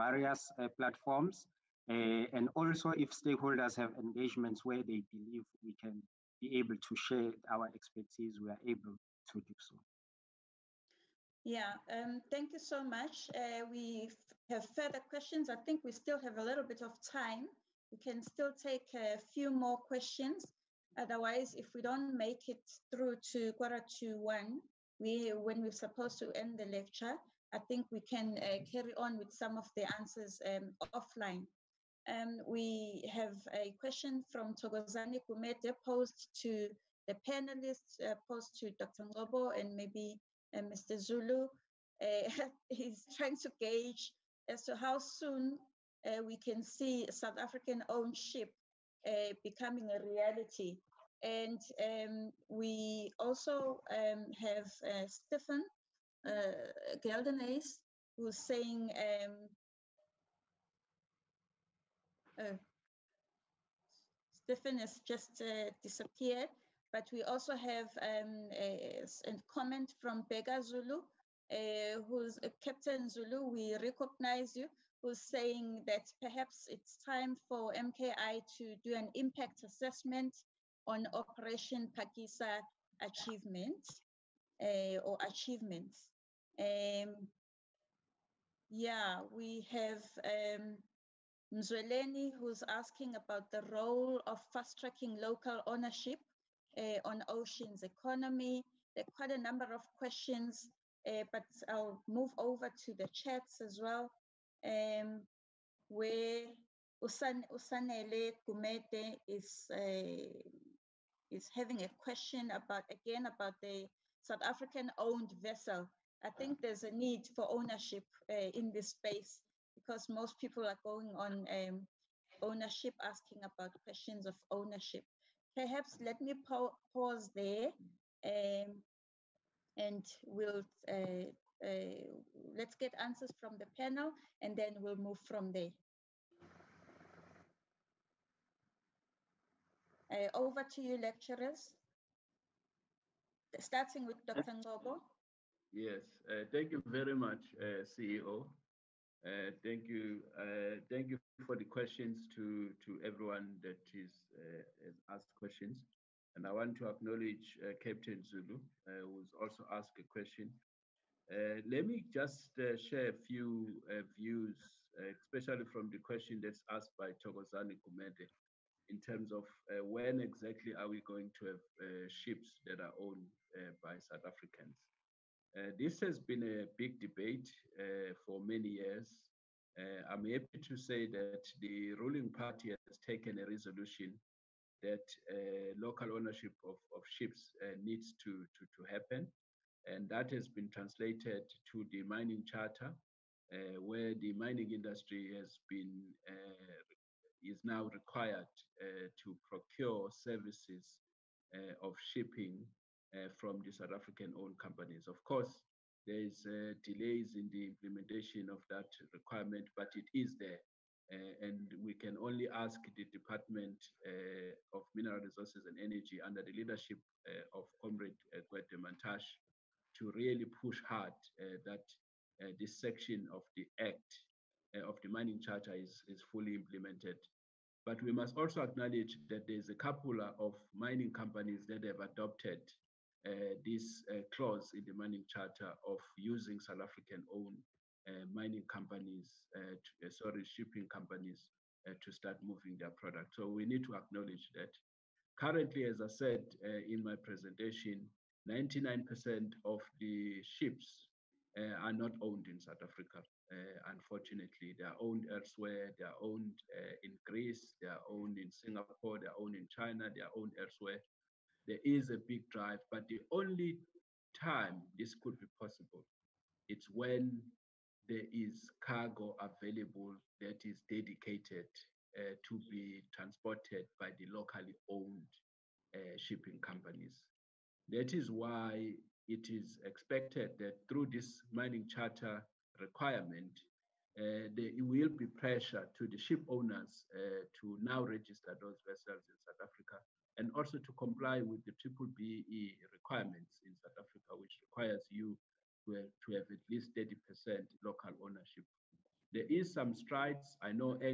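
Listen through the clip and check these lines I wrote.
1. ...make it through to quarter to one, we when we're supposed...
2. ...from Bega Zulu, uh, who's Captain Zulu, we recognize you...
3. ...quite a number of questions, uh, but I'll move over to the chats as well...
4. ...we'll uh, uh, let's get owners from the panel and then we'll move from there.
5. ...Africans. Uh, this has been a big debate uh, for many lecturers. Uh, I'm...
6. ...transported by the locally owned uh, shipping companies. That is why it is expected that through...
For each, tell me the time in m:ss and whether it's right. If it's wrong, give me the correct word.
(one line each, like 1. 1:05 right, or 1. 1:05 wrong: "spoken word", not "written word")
1. 0:22 right
2. 1:10 right
3. 1:39 right
4. 2:10 wrong: "answers", not "owners"
5. 2:54 wrong: "years", not "lecturers"
6. 4:33 right.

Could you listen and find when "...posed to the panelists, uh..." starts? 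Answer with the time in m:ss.
0:35.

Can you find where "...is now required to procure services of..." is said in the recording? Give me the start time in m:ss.
3:17.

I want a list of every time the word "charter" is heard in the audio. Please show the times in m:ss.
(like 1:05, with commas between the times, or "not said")
3:12, 3:45, 3:55, 4:41.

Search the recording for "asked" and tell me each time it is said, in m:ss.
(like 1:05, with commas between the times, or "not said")
2:35, 2:39, 2:46.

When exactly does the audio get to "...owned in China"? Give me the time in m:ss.
4:19.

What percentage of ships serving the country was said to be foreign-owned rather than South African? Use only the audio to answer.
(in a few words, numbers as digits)
99%.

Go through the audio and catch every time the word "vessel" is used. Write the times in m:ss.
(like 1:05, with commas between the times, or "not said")
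1:55, 4:48.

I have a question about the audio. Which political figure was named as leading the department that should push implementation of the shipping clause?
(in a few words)
Gwede Mantashe.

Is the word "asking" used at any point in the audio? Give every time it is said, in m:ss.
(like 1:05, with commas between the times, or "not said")
1:32, 2:03.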